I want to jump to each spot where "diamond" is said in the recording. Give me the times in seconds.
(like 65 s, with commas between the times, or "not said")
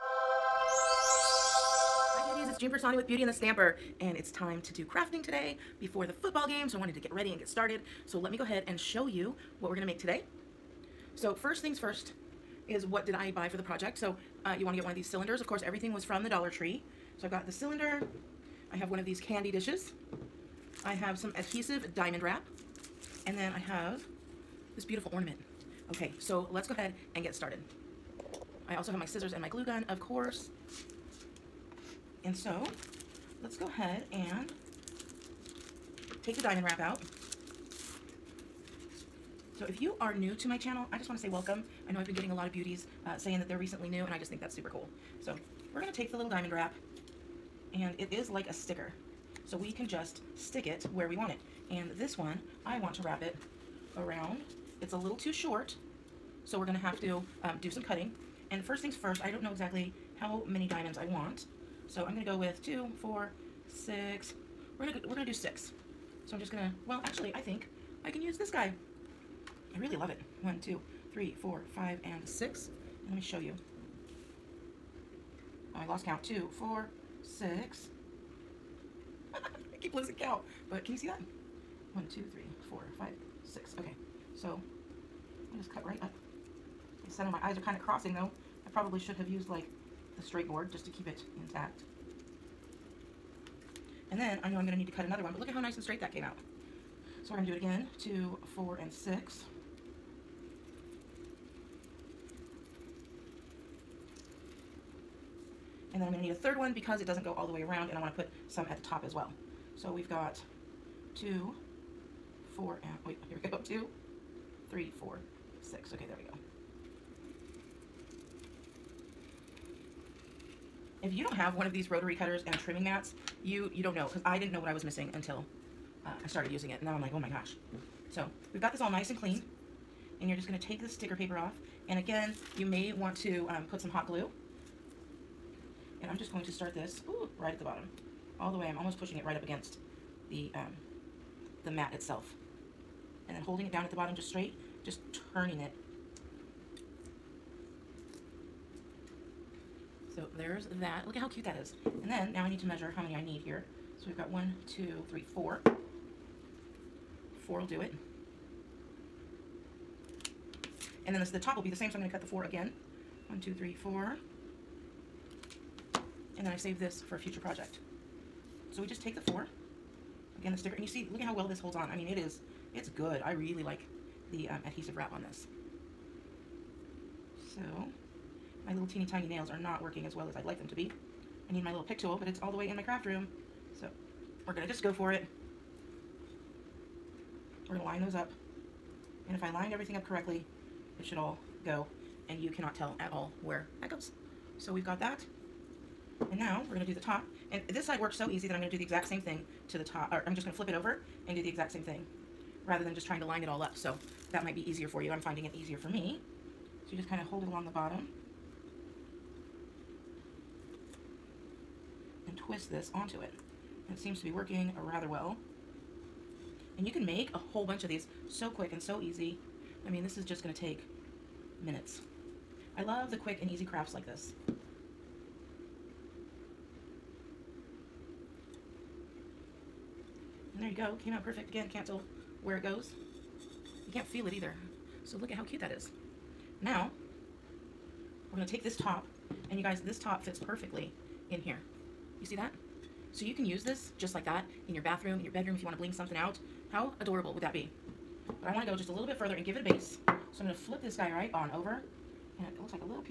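21 s, 36 s, 46 s, 60 s.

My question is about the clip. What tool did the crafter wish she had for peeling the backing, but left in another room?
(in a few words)
pick tool.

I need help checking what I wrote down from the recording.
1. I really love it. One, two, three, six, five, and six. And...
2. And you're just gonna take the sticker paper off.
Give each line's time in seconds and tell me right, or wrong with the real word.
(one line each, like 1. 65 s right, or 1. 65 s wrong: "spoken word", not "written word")
1. 69 s wrong: "four", not "six"
2. 130 s right.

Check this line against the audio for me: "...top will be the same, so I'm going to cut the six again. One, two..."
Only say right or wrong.
wrong.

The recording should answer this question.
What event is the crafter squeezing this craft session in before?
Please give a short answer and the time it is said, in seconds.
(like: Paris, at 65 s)
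the football game, at 6 s.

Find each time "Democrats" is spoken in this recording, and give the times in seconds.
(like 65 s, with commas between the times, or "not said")
not said.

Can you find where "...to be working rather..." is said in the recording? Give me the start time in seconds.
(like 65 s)
214 s.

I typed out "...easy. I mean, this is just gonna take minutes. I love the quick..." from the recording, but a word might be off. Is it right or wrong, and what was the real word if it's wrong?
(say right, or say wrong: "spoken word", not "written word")
right.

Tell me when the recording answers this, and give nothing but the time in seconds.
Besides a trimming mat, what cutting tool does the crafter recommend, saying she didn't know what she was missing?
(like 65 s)
121 s.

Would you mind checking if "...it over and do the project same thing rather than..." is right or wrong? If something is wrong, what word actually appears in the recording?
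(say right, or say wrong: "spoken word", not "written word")
wrong: "exact", not "project".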